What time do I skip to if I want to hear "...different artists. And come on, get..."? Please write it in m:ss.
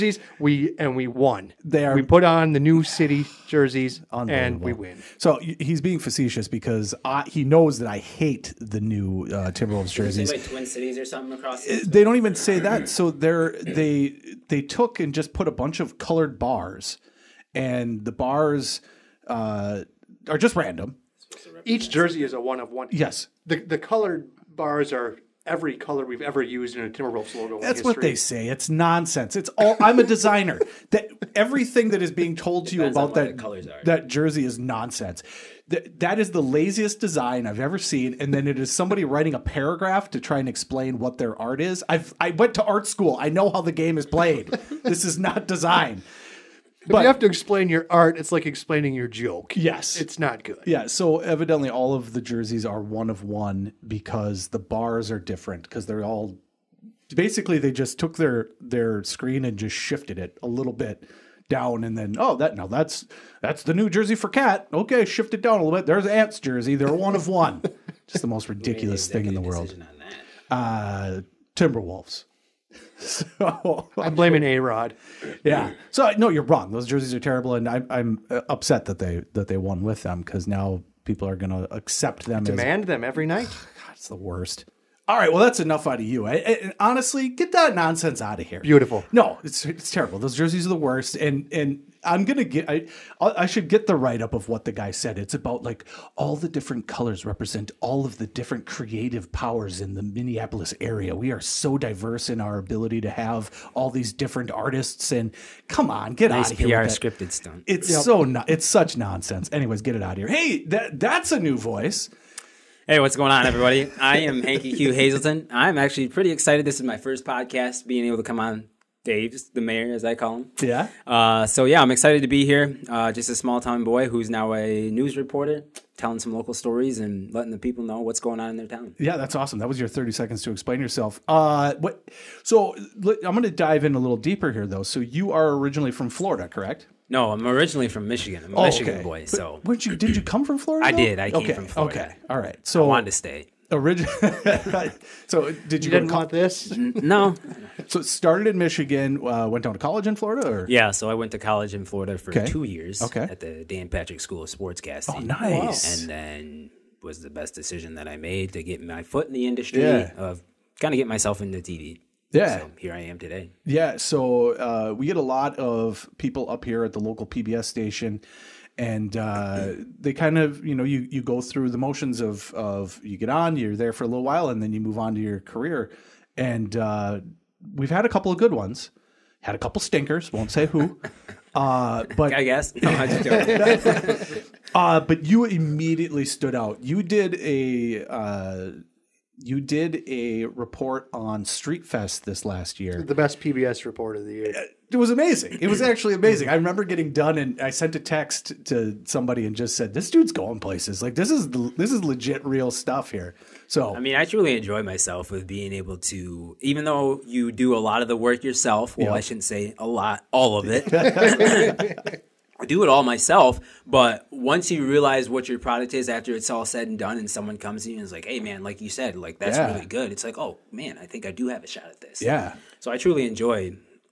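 1:44.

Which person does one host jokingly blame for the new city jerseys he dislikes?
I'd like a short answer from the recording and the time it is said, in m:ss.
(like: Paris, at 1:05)
A Rod, at 1:14.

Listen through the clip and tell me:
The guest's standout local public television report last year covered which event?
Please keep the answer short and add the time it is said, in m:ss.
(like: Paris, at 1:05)
Street Fest, at 3:11.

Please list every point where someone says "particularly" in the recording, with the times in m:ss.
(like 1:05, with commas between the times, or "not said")
not said.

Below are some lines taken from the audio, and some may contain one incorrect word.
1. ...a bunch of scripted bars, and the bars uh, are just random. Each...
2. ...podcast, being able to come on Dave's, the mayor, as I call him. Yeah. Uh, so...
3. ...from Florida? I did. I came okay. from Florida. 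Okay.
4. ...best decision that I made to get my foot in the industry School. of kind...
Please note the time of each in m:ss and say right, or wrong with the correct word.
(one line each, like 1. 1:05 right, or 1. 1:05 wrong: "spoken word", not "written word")
1. 0:15 wrong: "colored", not "scripted"
2. 1:57 right
3. 2:20 right
4. 2:37 wrong: "Yeah", not "School".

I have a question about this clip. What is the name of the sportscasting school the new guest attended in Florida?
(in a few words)
Dan Patrick School of Sportscasting.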